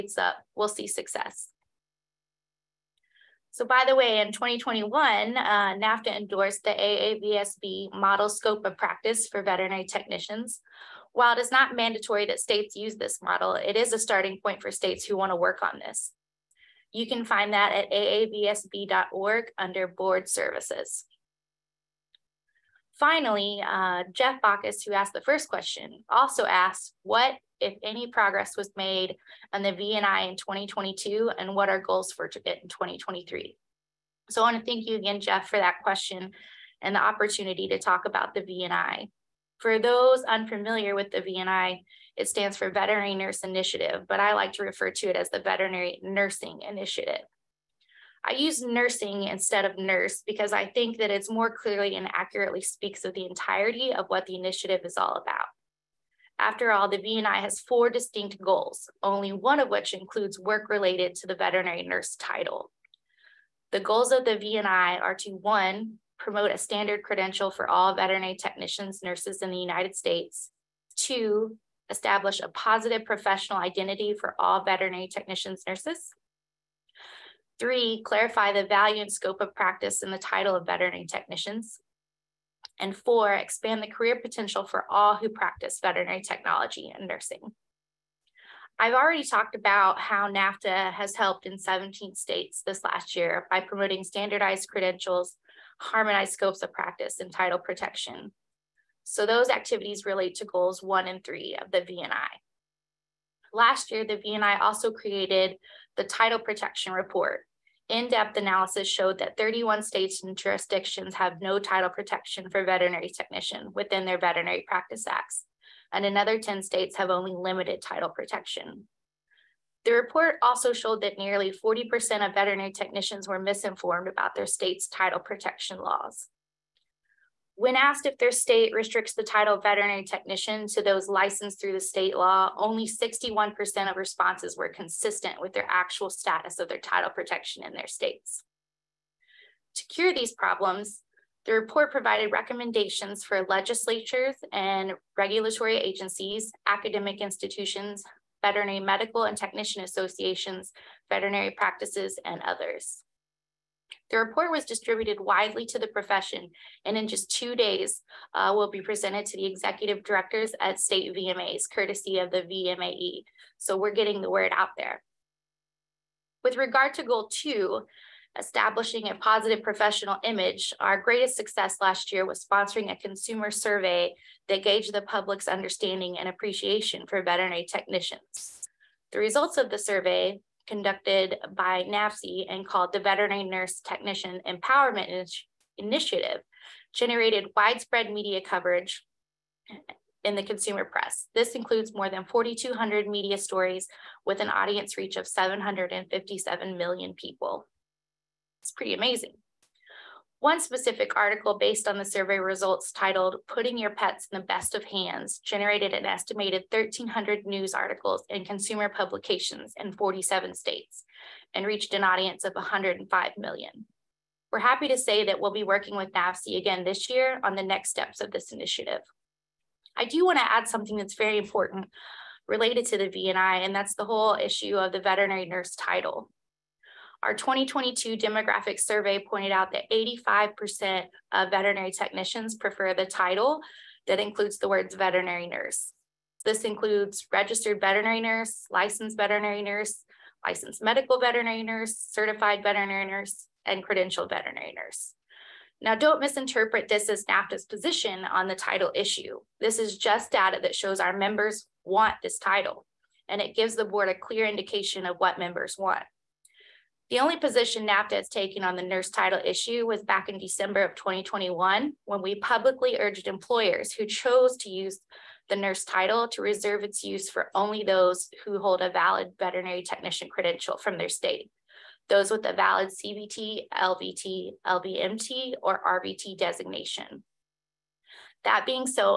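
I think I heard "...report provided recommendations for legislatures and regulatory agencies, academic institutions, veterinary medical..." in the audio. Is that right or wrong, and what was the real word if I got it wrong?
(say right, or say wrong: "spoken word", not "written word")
right.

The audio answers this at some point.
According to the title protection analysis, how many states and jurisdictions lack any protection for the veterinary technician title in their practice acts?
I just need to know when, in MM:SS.
01:49.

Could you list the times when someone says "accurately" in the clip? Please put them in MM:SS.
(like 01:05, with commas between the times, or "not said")
00:52.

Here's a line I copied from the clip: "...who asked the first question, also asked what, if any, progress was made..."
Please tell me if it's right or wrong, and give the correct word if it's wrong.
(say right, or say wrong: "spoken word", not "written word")
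right.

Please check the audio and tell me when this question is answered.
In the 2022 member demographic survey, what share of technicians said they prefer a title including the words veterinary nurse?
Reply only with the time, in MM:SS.
03:49.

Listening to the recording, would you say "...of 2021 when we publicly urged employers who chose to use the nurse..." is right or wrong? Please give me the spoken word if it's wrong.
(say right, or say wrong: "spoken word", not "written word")
right.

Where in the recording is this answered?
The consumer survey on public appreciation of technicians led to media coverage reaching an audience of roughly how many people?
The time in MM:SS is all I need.
03:15.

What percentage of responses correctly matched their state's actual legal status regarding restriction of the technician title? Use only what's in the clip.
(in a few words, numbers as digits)
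61%.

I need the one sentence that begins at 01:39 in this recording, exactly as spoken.
So those activities relate to goals one and three of the VNI.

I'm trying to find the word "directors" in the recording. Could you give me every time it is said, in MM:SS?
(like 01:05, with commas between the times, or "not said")
02:40.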